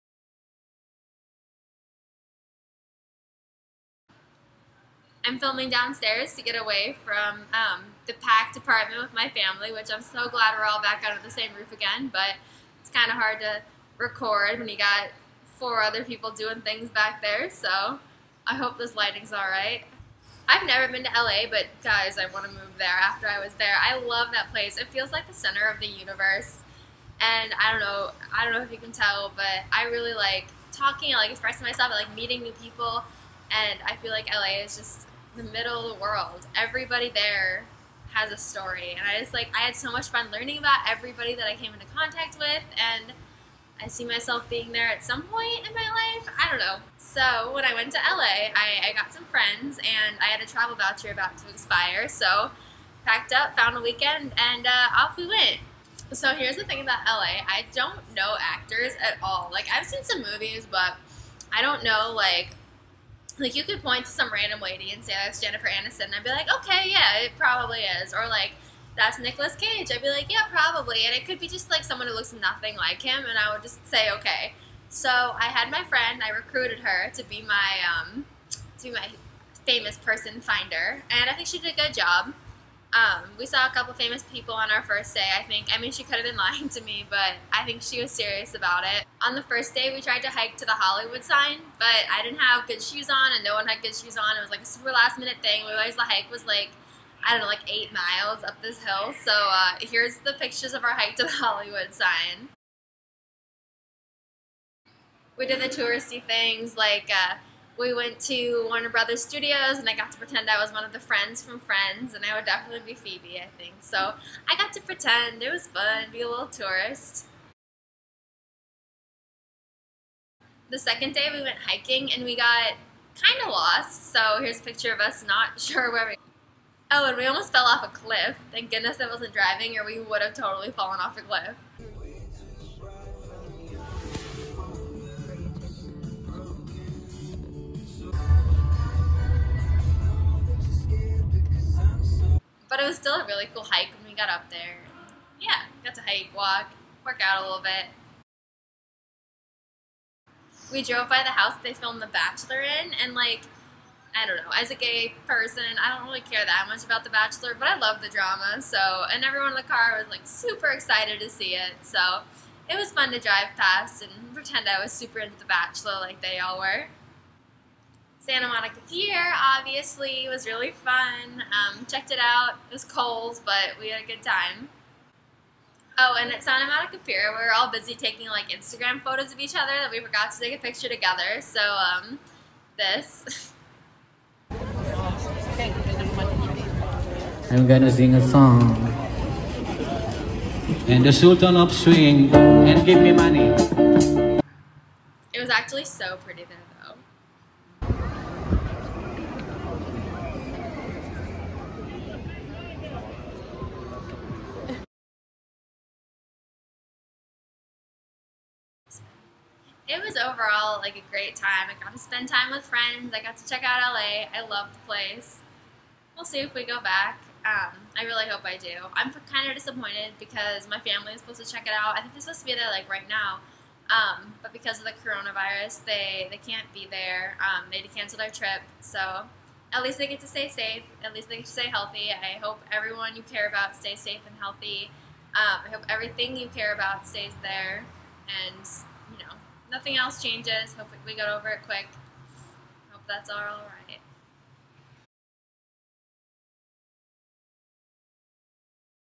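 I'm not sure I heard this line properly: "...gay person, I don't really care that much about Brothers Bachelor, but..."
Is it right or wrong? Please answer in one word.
wrong.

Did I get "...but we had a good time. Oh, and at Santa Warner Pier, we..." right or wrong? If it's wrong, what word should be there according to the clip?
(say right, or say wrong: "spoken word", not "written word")
wrong: "Monica", not "Warner".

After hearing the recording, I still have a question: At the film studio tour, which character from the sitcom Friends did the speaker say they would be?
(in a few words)
Phoebe.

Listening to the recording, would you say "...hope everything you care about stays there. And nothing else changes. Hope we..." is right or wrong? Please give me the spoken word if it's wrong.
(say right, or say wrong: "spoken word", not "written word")
right.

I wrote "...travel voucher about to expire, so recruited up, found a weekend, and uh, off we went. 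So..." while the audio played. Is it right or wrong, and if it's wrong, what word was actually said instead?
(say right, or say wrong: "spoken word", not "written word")
wrong: "packed", not "recruited".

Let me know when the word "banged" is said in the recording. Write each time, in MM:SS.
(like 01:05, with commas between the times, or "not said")
not said.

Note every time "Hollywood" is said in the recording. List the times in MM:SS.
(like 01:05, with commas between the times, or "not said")
01:30, 01:41.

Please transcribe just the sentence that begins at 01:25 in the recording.
I mean, she could have been lying to me, but I think she was serious about it.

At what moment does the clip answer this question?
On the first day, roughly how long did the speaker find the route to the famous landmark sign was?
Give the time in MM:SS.
01:37.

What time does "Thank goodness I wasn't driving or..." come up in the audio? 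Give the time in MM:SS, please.
02:08.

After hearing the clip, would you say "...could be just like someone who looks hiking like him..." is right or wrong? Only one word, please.
wrong.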